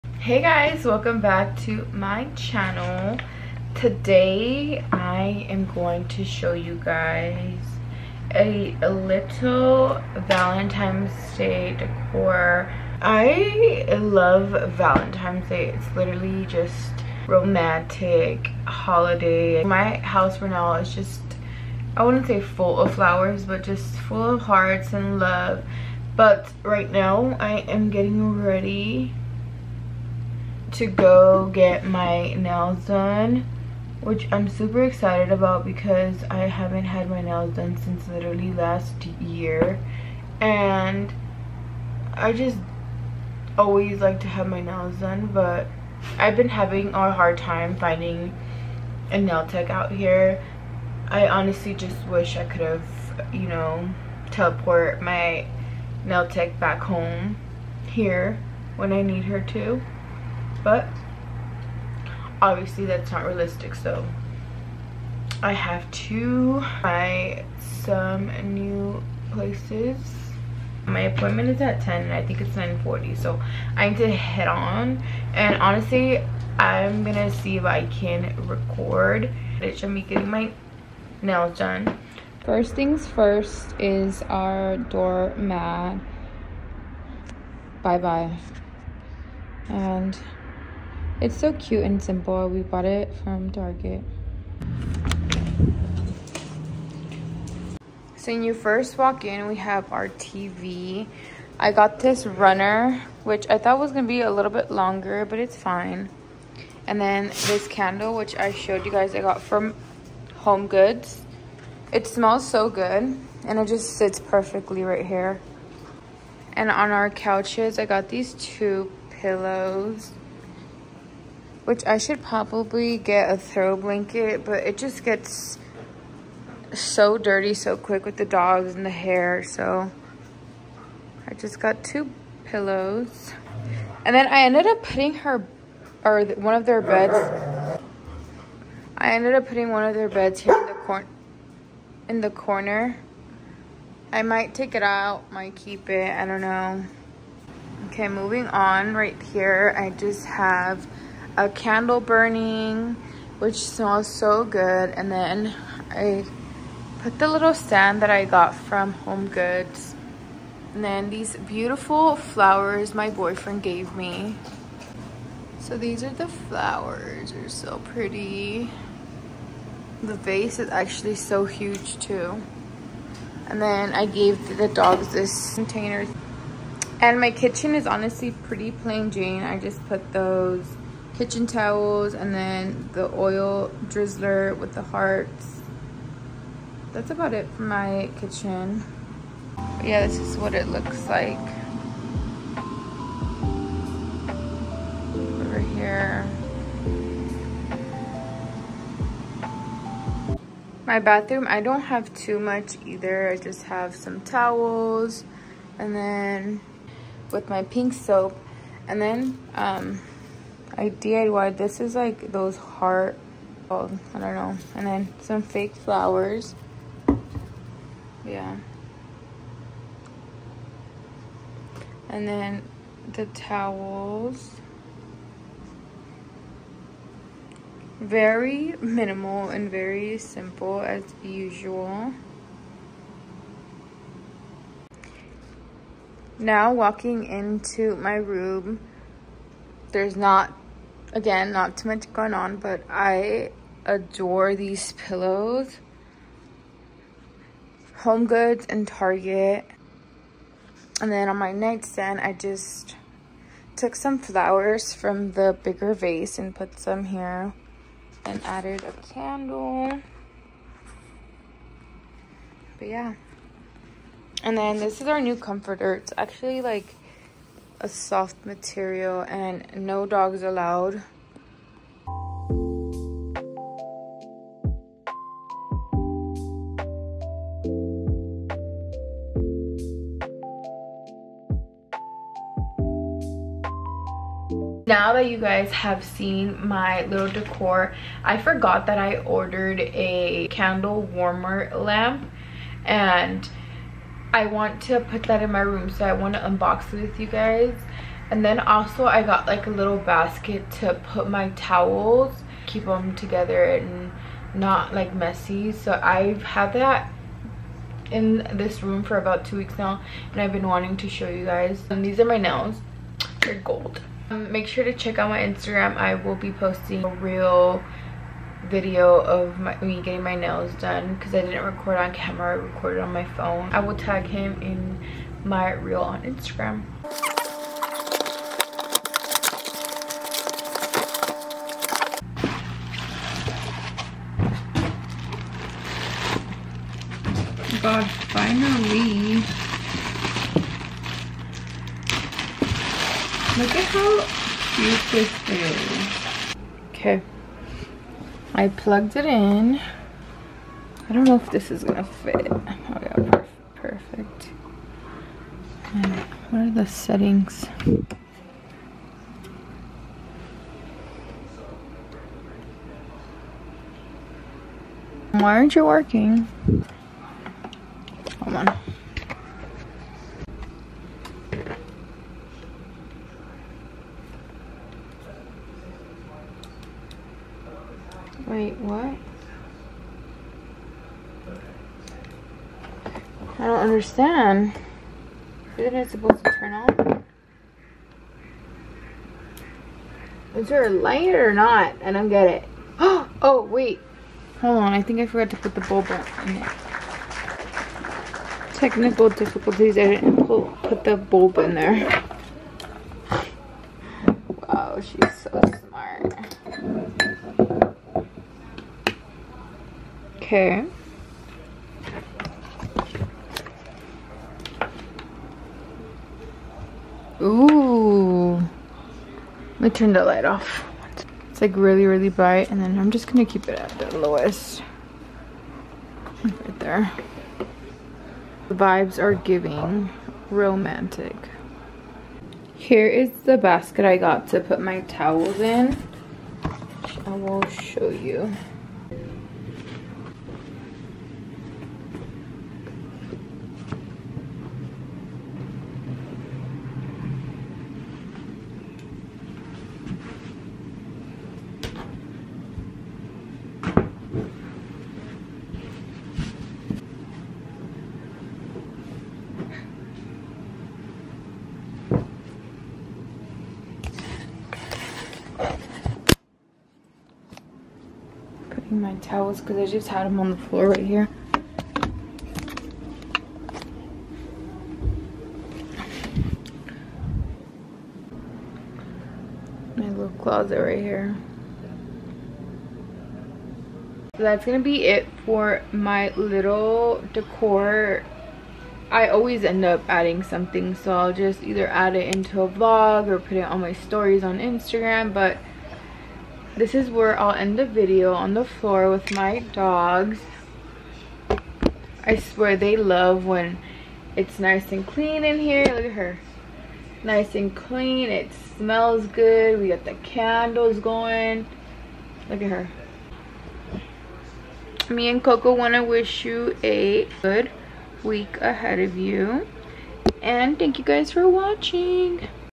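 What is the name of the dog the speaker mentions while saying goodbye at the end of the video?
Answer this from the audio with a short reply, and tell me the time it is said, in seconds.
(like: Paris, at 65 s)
Coco, at 515 s.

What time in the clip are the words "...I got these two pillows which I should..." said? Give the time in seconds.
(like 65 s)
117 s.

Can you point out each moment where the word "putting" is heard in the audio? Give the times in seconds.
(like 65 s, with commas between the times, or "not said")
134 s, 139 s.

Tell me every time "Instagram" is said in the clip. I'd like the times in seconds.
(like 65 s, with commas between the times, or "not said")
315 s, 326 s, 494 s.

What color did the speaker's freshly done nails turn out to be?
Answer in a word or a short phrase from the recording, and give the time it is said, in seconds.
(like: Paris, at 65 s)
gold, at 313 s.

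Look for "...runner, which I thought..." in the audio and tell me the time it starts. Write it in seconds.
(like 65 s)
102 s.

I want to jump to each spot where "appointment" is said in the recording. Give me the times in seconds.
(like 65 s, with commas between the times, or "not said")
71 s.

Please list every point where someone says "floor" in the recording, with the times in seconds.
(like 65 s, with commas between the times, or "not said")
470 s, 498 s.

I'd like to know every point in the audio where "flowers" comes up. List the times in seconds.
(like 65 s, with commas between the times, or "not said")
22 s, 162 s, 166 s, 215 s, 254 s.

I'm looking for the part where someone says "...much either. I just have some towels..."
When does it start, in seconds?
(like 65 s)
202 s.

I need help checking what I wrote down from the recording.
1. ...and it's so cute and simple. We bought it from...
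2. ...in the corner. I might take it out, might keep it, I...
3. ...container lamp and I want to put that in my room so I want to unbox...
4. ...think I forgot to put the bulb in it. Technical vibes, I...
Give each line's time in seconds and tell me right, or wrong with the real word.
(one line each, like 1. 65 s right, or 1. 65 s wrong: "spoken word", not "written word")
1. 89 s right
2. 142 s right
3. 291 s wrong: "warmer", not "container"
4. 395 s wrong: "difficulties", not "vibes".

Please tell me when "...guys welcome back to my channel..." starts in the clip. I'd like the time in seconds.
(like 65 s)
0 s.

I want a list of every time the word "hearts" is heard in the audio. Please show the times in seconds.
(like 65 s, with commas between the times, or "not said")
24 s, 184 s, 212 s.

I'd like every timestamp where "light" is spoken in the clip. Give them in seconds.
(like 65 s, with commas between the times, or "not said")
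390 s, 420 s.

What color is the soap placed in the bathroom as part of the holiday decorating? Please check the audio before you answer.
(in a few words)
pink.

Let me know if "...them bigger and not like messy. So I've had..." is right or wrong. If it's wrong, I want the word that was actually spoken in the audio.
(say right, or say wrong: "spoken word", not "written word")
wrong: "together", not "bigger".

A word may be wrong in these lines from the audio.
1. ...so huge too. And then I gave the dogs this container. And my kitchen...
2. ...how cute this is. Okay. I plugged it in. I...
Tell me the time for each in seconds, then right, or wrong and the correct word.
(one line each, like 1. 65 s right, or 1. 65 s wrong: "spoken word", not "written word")
1. 171 s right
2. 344 s right.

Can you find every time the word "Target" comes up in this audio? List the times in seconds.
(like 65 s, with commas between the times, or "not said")
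93 s, 248 s.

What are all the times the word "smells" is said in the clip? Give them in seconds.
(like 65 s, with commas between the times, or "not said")
112 s, 153 s, 508 s.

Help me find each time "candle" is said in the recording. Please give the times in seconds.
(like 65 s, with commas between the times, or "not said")
107 s, 151 s, 259 s, 290 s, 510 s.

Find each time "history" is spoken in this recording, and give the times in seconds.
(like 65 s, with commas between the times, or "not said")
not said.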